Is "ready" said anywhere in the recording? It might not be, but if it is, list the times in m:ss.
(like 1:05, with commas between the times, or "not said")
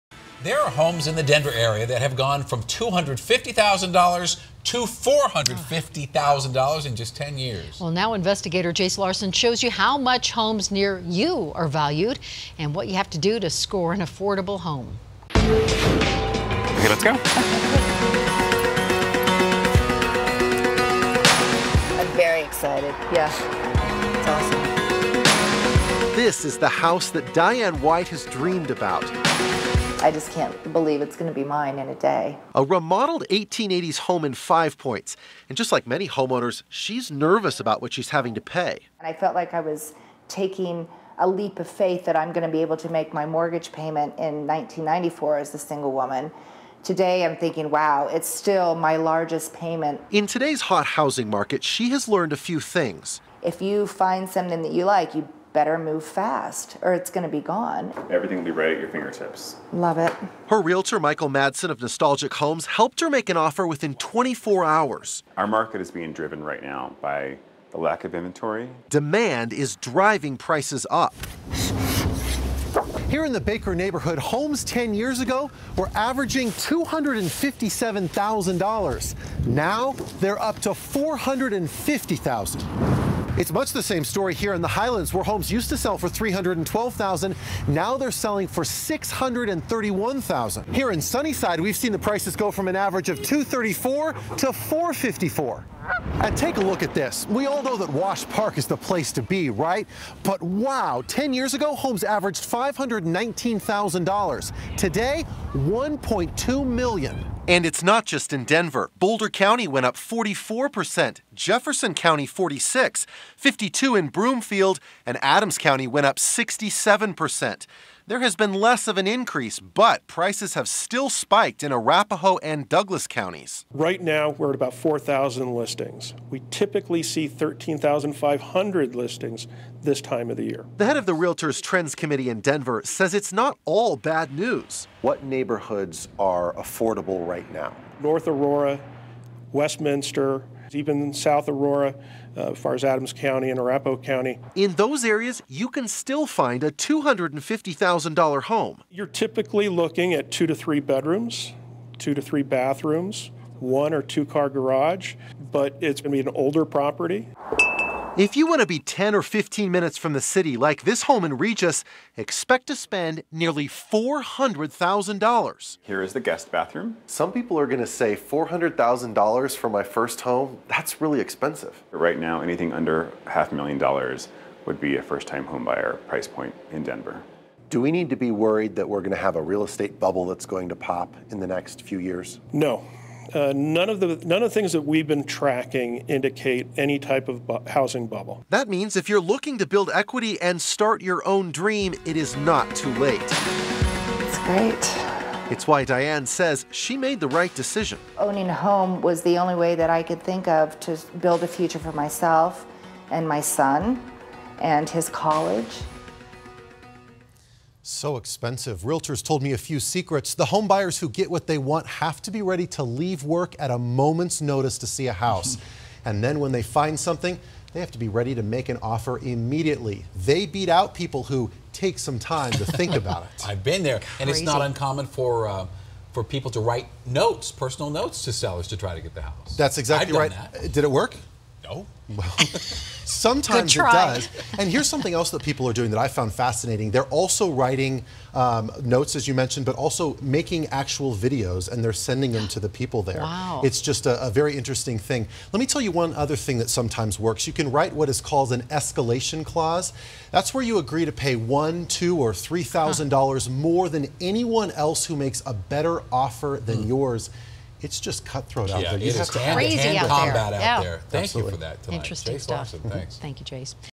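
3:32, 3:38.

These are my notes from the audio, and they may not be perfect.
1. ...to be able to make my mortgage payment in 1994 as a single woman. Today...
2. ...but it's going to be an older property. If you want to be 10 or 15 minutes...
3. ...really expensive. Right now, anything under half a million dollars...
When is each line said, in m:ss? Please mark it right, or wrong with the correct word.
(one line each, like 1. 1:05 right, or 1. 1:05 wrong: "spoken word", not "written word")
1. 0:42 right
2. 2:35 right
3. 2:50 right.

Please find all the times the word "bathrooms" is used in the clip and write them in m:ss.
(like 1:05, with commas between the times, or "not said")
2:32, 2:46.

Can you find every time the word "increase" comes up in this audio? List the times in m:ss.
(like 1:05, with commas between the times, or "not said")
1:59.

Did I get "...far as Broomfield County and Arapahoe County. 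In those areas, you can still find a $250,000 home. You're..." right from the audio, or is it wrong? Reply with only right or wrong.
wrong.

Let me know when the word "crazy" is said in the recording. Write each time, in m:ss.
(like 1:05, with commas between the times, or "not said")
3:43, 4:19.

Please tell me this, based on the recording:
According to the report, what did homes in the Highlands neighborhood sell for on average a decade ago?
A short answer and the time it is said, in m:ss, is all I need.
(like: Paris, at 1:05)
$312,000, at 1:26.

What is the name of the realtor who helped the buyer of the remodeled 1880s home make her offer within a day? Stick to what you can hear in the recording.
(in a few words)
Michael Madsen.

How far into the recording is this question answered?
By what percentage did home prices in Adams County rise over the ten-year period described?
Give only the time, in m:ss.
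1:56.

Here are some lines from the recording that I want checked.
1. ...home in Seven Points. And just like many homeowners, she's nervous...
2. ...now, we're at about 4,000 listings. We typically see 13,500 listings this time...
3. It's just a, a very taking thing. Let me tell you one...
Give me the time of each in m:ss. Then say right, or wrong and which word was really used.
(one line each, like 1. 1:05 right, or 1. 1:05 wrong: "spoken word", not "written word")
1. 0:33 wrong: "Five", not "Seven"
2. 2:04 right
3. 4:03 wrong: "interesting", not "taking".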